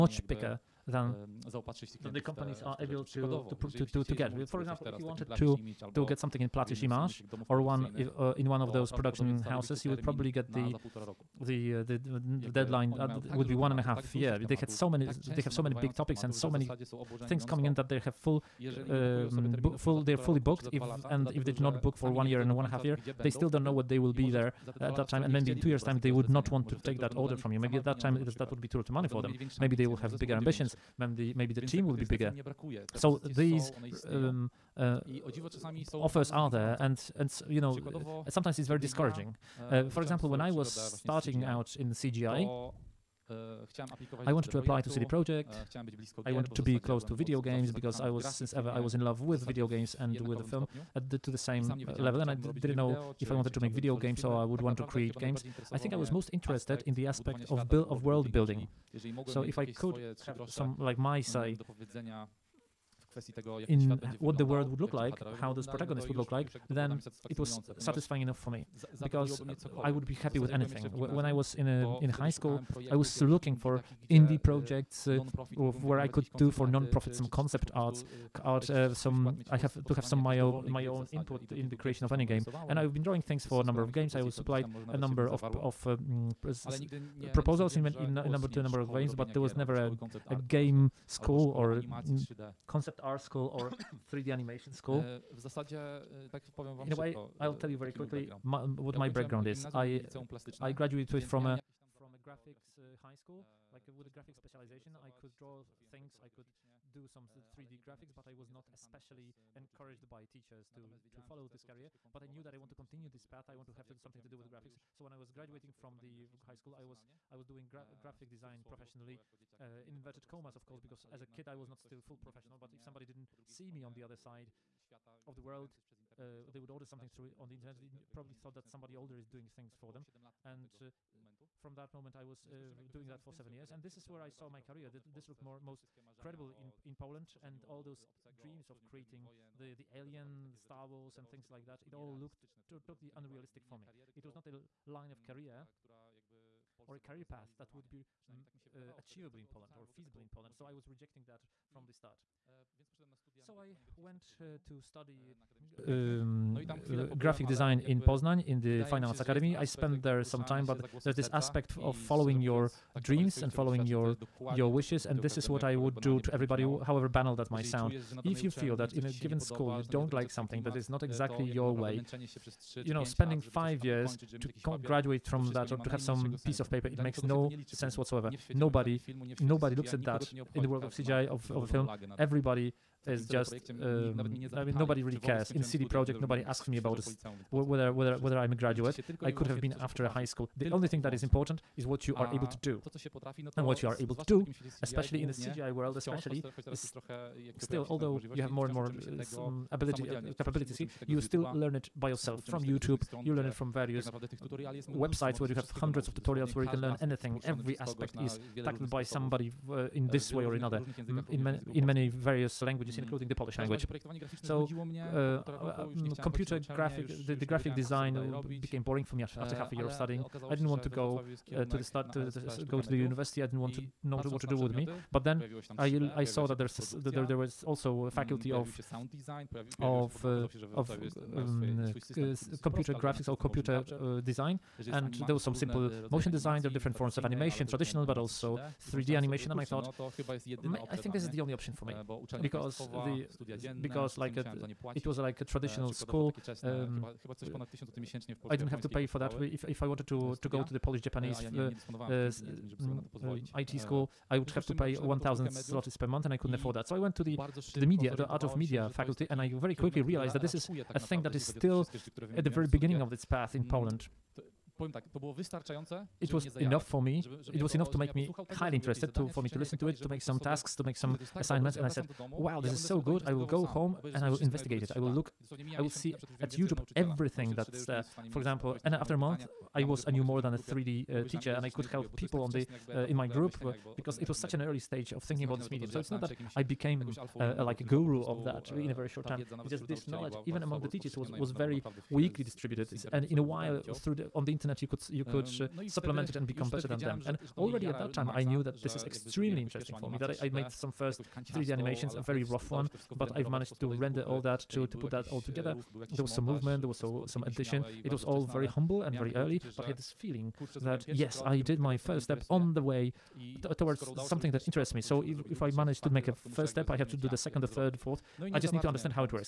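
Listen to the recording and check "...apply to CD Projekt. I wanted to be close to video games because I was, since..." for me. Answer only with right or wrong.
right.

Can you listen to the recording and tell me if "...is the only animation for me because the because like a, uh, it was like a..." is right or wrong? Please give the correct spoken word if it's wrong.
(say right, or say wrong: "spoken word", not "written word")
wrong: "option", not "animation".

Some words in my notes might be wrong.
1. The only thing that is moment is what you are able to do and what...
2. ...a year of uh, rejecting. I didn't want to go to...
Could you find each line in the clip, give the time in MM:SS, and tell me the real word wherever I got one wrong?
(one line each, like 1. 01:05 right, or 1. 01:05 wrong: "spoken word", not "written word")
1. 03:10 wrong: "important", not "moment"
2. 03:39 wrong: "studying", not "rejecting".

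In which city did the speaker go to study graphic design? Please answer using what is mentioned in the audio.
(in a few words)
Poznań.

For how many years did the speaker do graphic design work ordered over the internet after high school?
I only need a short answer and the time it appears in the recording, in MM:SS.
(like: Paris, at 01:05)
7, at 02:13.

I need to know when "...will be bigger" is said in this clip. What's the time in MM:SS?
00:31.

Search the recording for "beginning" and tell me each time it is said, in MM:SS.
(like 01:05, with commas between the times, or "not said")
04:22.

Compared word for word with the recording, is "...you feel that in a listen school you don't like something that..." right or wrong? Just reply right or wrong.
wrong.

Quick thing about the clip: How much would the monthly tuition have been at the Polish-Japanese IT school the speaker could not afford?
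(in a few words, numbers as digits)
1000 zlotys.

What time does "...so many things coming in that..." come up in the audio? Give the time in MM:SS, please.
00:16.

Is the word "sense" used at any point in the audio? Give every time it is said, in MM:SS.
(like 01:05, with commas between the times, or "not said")
02:57.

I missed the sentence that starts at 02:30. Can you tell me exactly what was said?
So I was rejecting that from the start.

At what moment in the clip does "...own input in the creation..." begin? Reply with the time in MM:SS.
01:20.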